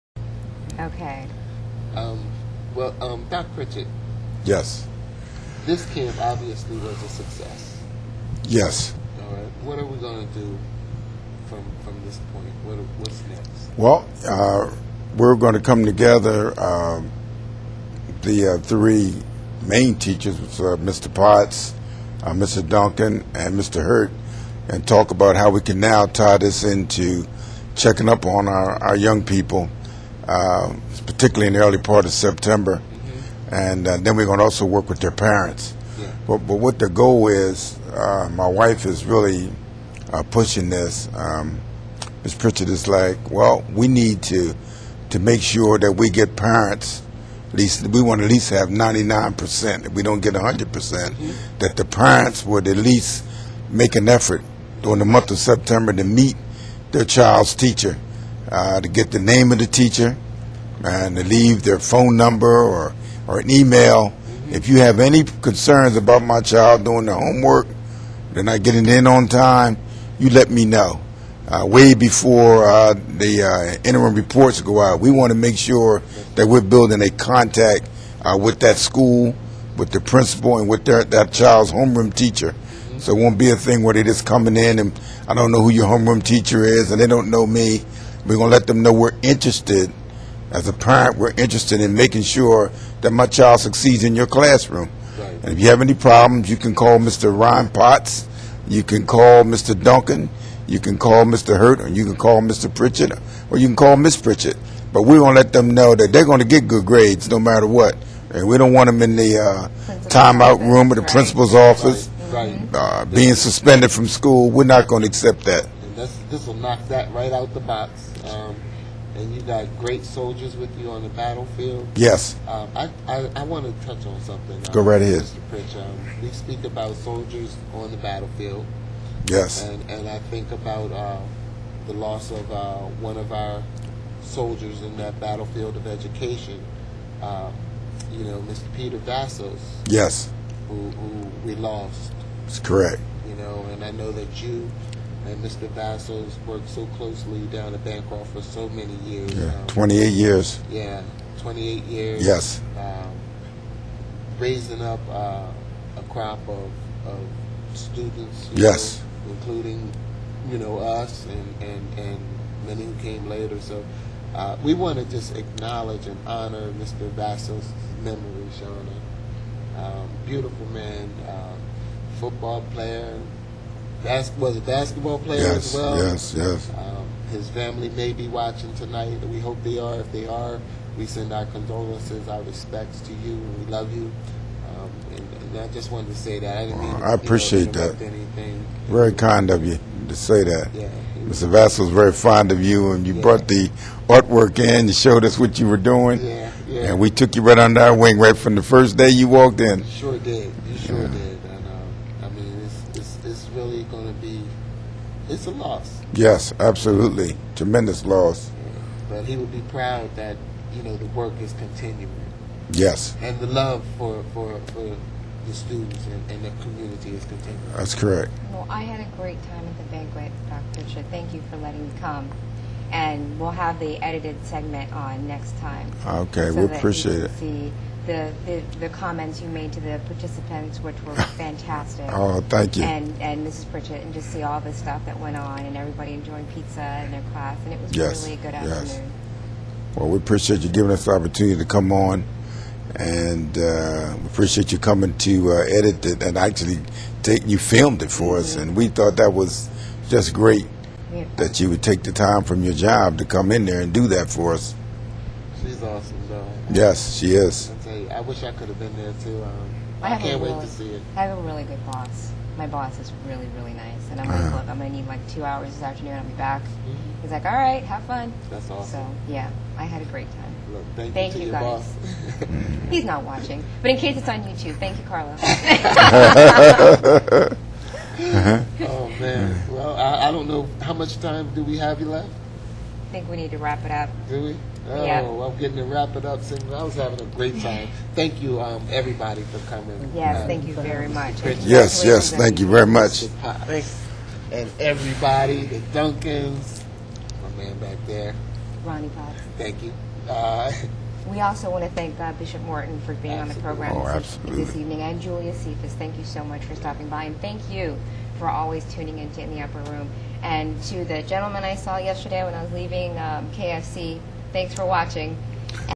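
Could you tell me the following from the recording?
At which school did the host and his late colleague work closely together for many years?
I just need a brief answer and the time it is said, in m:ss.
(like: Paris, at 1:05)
Bancroft, at 2:27.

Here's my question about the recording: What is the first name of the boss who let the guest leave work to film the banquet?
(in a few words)
Carlos.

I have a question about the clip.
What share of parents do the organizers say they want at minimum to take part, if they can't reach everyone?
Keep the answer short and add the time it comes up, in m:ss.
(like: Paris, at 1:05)
99%, at 0:48.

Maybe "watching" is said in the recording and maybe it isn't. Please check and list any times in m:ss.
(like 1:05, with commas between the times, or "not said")
2:58, 4:33, 5:14.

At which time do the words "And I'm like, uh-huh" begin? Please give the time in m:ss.
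4:24.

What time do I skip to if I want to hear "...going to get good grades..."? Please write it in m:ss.
1:46.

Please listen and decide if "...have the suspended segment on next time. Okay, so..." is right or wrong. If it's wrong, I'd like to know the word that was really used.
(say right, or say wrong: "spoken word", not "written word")
wrong: "edited", not "suspended".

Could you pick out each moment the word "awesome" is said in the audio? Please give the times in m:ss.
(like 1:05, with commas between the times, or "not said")
4:15, 4:28.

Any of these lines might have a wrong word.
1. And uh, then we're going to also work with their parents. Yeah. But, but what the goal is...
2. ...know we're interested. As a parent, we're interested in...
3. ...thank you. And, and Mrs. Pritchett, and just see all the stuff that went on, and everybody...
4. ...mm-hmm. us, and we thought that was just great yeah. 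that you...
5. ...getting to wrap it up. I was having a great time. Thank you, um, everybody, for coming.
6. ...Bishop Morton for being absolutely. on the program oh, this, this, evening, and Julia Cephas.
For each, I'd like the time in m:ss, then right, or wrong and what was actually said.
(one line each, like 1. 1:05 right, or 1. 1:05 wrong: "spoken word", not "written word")
1. 0:33 right
2. 1:28 right
3. 3:52 right
4. 4:08 right
5. 4:45 right
6. 5:02 right.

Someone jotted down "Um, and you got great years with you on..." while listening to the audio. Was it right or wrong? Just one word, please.
wrong.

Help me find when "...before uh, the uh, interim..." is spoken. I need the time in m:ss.
1:11.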